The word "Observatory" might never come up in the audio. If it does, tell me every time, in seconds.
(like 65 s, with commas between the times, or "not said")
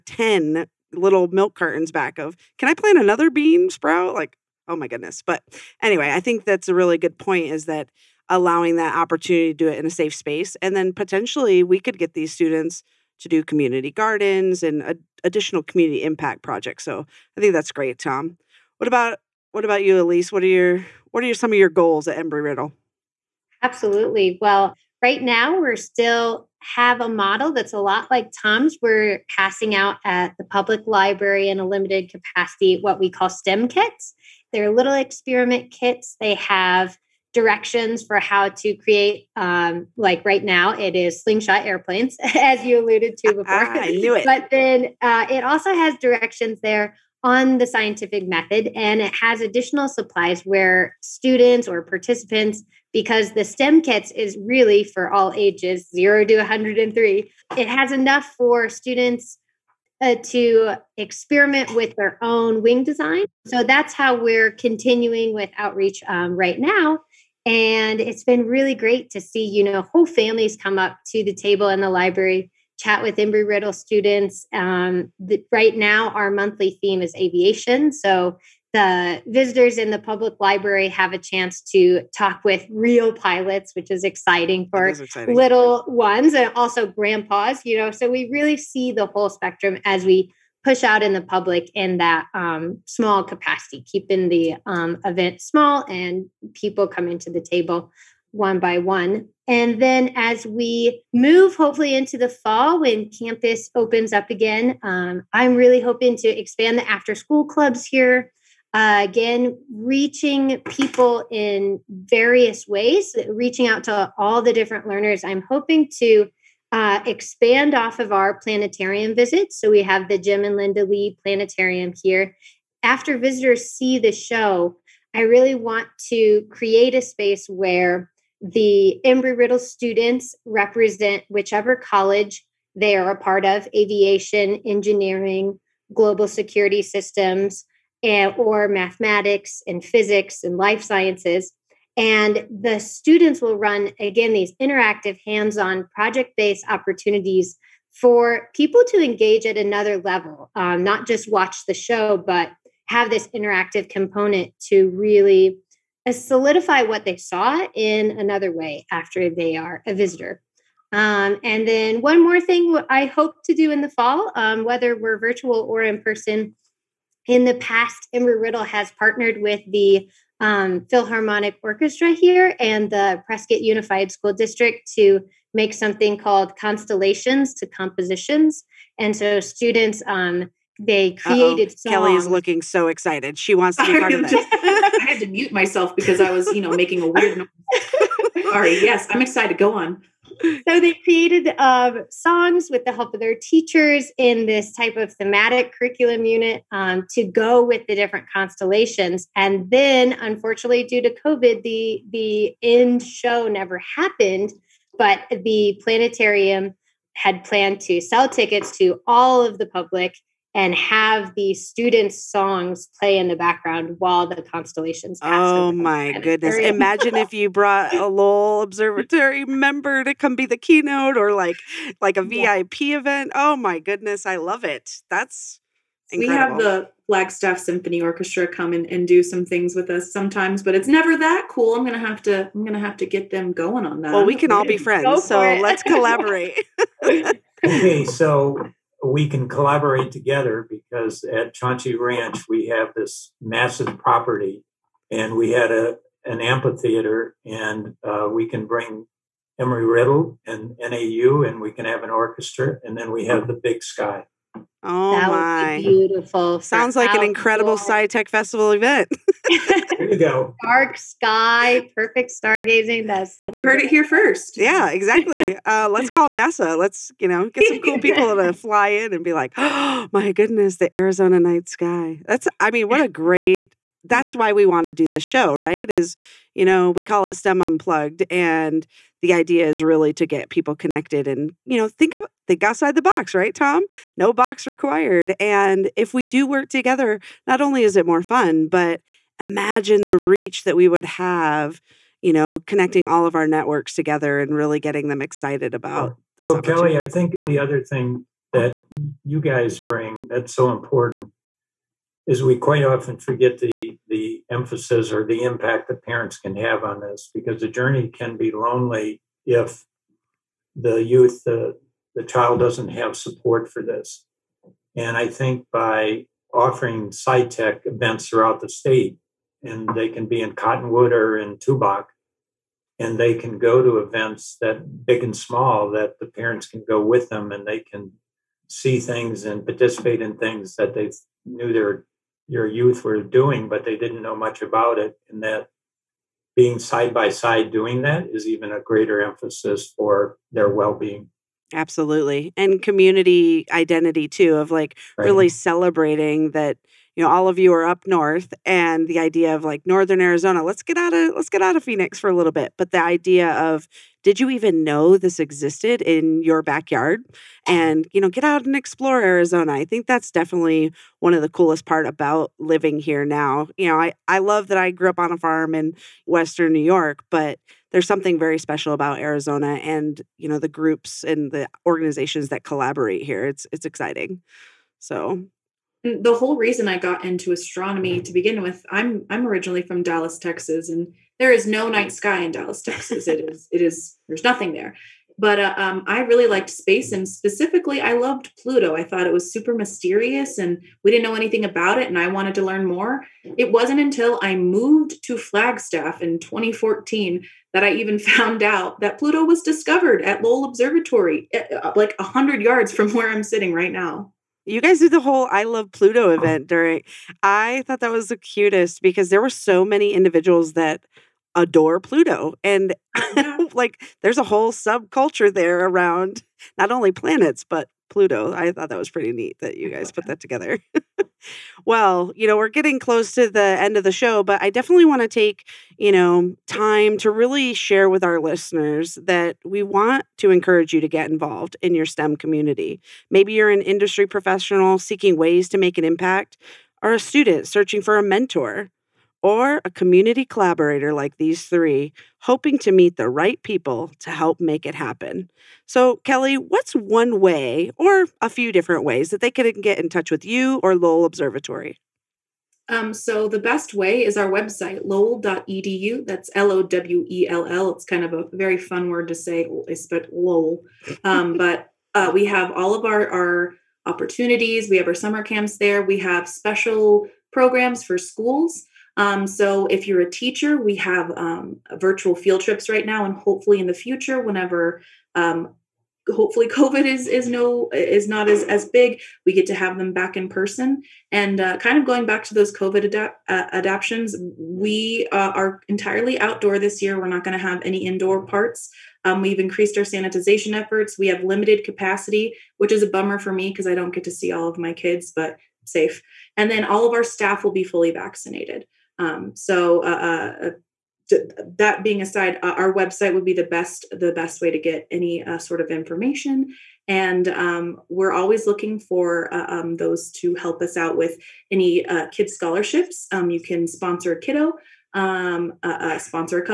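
218 s, 400 s, 451 s.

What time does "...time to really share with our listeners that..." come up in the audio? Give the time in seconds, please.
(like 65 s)
426 s.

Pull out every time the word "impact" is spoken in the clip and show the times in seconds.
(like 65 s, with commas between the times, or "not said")
16 s, 305 s, 436 s.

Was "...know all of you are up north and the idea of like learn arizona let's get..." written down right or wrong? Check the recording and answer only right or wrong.
wrong.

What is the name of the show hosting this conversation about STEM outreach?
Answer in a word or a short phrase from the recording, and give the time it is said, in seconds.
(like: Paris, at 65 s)
STEM Unplugged, at 277 s.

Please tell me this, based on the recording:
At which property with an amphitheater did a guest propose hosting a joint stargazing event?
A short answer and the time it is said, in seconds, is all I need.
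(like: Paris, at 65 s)
Chauncey Ranch, at 241 s.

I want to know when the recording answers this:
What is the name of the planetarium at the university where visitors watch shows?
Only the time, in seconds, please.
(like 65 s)
120 s.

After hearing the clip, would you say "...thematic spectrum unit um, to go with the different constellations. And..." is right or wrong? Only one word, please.
wrong.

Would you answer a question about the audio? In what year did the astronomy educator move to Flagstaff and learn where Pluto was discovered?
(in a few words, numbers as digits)
2014.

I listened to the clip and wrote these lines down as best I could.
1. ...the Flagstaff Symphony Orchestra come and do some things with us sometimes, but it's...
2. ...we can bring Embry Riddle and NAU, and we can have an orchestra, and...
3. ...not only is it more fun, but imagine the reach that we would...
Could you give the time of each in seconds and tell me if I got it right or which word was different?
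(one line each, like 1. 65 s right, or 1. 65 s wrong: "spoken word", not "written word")
1. 226 s right
2. 248 s right
3. 287 s right.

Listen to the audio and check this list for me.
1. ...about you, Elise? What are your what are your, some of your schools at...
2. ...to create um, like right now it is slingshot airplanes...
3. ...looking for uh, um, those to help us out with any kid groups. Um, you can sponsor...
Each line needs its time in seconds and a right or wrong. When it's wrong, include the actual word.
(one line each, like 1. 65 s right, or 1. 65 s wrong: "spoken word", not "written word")
1. 19 s wrong: "goals", not "schools"
2. 38 s right
3. 508 s wrong: "scholarships", not "groups".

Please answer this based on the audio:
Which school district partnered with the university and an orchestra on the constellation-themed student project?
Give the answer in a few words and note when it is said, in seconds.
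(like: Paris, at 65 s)
Prescott Unified School District, at 173 s.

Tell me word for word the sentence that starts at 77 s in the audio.
So the visitors in the public library have a chance to talk with real pilots, which is exciting for is exciting.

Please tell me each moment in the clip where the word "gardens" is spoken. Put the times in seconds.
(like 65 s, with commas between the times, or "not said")
13 s.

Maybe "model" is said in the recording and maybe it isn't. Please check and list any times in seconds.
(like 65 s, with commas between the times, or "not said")
27 s.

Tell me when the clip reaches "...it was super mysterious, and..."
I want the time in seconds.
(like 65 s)
389 s.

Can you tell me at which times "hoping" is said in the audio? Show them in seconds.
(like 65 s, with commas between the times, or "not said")
105 s, 115 s, 442 s.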